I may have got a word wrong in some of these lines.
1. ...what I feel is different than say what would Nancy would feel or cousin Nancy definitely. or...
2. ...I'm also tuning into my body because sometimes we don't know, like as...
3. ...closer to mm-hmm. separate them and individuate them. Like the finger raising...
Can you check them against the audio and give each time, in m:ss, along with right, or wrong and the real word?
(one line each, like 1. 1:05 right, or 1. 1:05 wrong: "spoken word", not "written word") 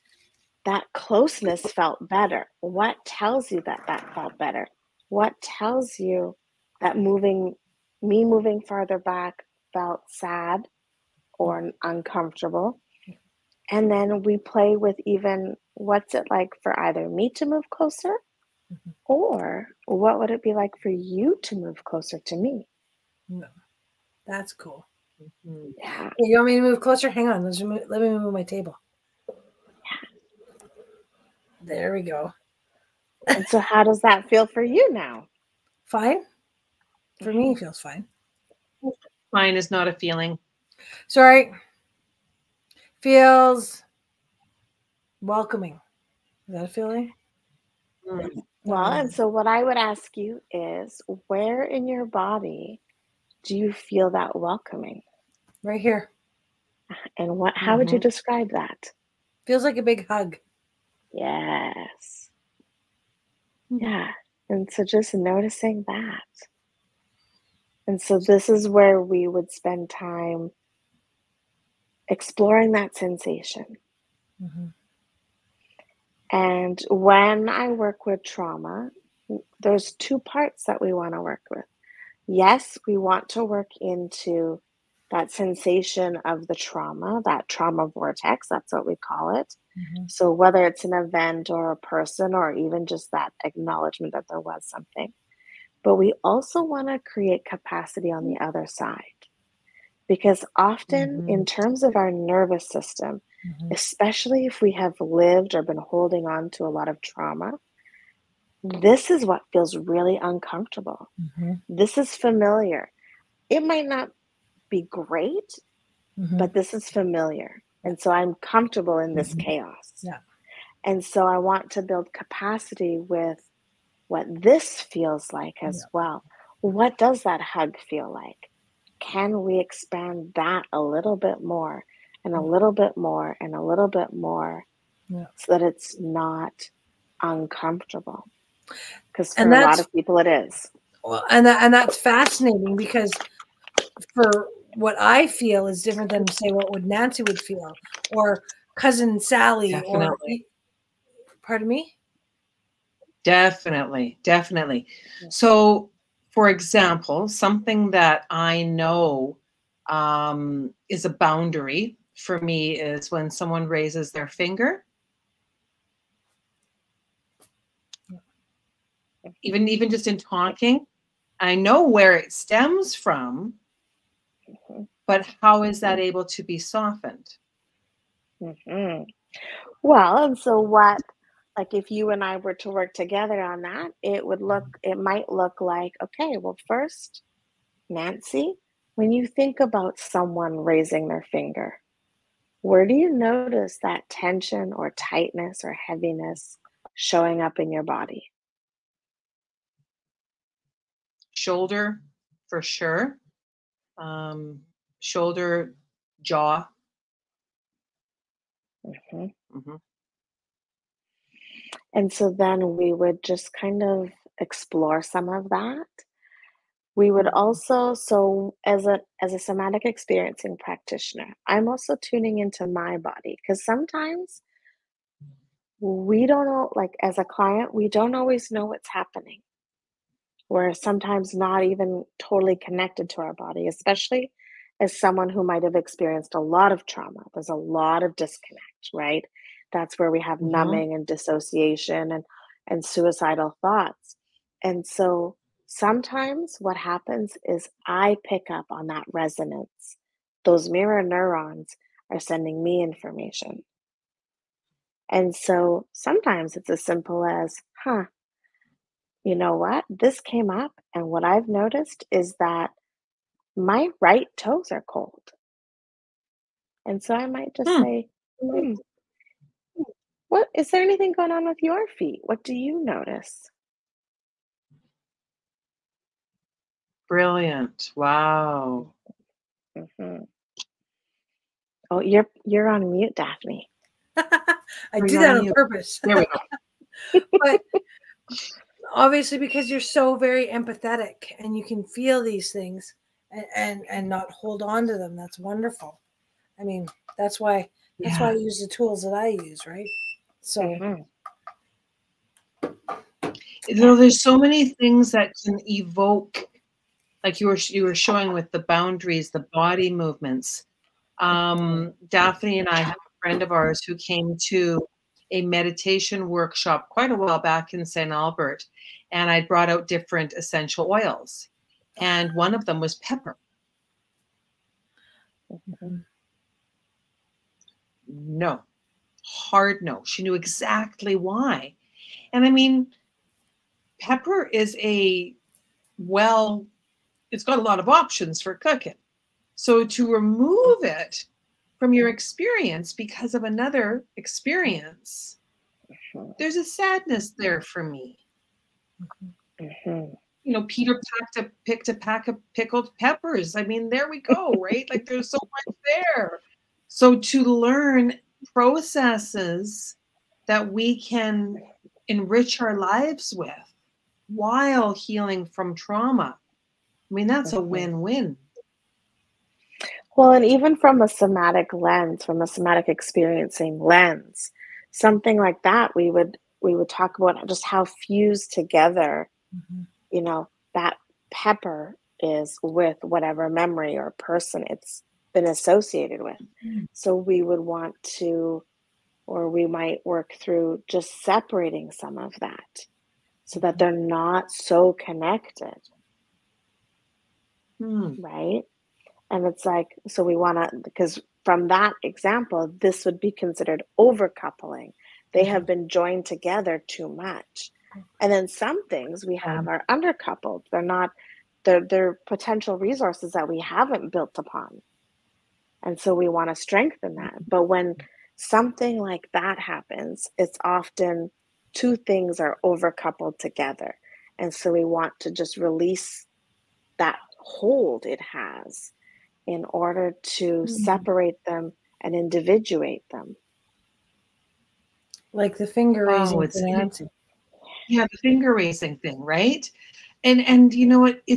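1. 2:24 wrong: "Sally", not "Nancy"
2. 3:41 right
3. 7:09 wrong: "order", not "closer".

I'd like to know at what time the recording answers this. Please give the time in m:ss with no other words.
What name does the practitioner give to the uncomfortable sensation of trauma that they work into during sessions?
1:27.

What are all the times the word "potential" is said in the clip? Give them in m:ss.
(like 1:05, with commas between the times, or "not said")
6:52.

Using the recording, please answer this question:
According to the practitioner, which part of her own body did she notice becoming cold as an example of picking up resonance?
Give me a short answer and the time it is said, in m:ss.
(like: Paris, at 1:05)
Right toes, at 4:24.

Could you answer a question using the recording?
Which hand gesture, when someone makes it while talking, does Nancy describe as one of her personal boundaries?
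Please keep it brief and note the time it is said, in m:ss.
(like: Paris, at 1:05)
Raising their finger, at 2:43.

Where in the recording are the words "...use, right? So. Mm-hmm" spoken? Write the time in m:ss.
4:59.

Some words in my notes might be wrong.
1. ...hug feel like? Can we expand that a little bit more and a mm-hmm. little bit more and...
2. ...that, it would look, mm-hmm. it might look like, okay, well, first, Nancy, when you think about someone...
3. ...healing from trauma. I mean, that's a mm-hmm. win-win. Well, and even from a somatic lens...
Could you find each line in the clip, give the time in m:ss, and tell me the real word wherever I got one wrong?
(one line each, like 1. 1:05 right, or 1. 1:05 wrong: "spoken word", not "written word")
1. 2:07 right
2. 3:03 right
3. 6:04 right.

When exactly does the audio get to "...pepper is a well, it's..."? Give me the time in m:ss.
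5:34.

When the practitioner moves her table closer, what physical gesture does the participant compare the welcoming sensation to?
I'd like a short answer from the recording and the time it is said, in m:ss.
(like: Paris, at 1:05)
A big hug, at 0:59.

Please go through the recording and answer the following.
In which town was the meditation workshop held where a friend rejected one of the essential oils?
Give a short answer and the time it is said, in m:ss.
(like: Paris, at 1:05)
St. Albert, at 5:17.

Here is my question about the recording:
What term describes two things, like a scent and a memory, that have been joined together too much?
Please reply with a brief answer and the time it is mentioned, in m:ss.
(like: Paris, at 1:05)
Overcoupling, at 6:43.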